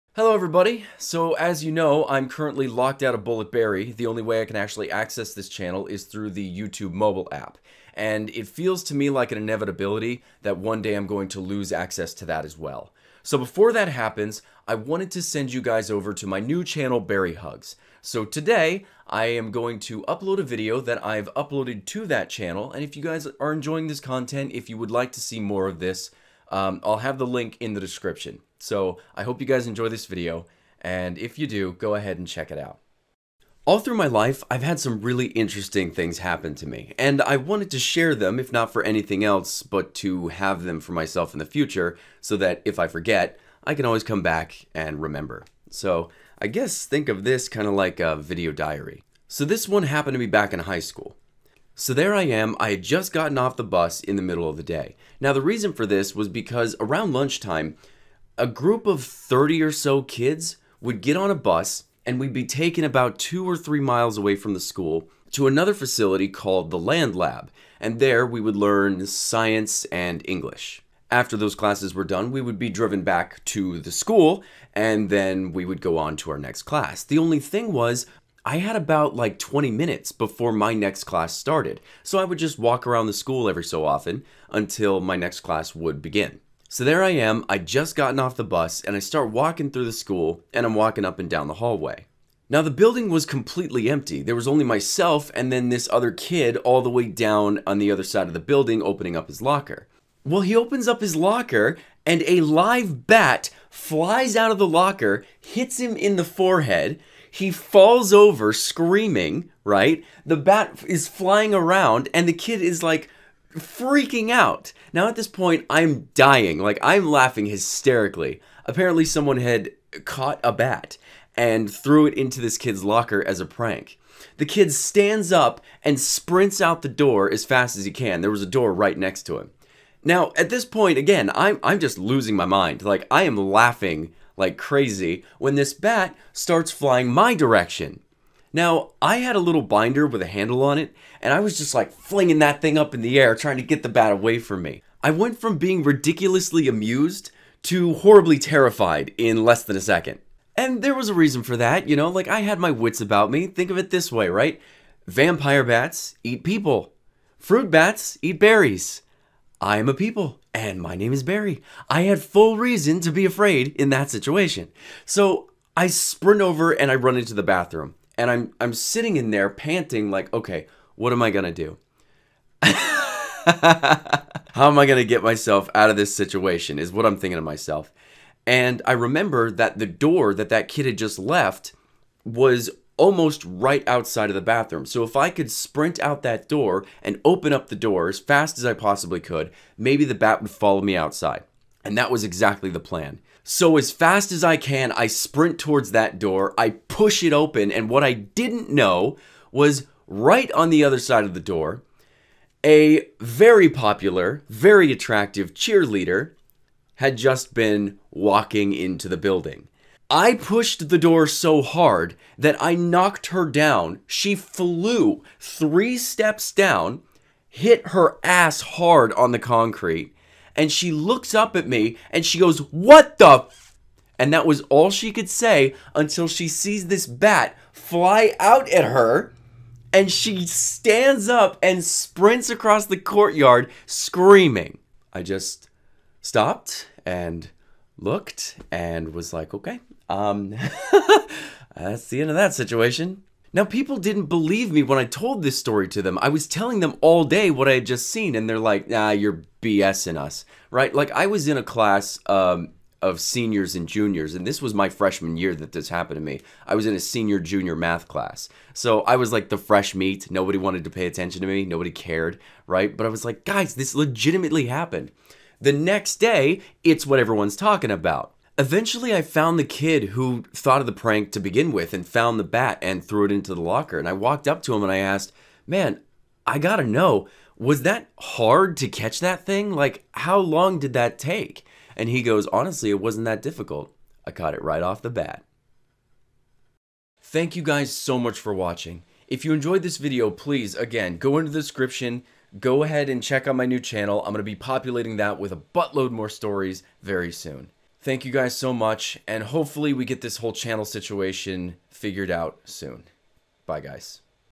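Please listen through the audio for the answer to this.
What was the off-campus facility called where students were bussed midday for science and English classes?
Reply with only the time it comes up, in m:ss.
1:06.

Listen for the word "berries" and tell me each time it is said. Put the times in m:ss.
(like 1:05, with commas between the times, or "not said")
2:38.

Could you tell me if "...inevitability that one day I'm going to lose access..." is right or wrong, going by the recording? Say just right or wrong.
right.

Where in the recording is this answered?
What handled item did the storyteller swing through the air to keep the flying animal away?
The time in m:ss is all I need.
2:19.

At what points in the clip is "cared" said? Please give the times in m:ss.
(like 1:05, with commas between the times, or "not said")
4:21.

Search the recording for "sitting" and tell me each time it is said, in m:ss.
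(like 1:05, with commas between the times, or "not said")
2:48.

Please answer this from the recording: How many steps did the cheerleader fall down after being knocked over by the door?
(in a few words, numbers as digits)
3.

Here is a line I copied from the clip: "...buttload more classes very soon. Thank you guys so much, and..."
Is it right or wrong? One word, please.
wrong.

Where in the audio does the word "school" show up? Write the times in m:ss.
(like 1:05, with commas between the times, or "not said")
0:50, 1:04, 1:13, 1:23, 1:29.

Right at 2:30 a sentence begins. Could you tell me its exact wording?
And there was a reason for that, you know, like I had my wits about me.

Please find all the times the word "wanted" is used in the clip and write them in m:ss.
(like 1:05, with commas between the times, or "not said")
0:14, 0:37, 4:20.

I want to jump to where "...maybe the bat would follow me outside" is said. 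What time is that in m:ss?
3:09.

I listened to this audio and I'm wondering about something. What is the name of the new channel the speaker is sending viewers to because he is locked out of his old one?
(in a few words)
Barry Hugs.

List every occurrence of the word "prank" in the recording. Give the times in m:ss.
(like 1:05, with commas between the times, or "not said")
2:03, 4:30.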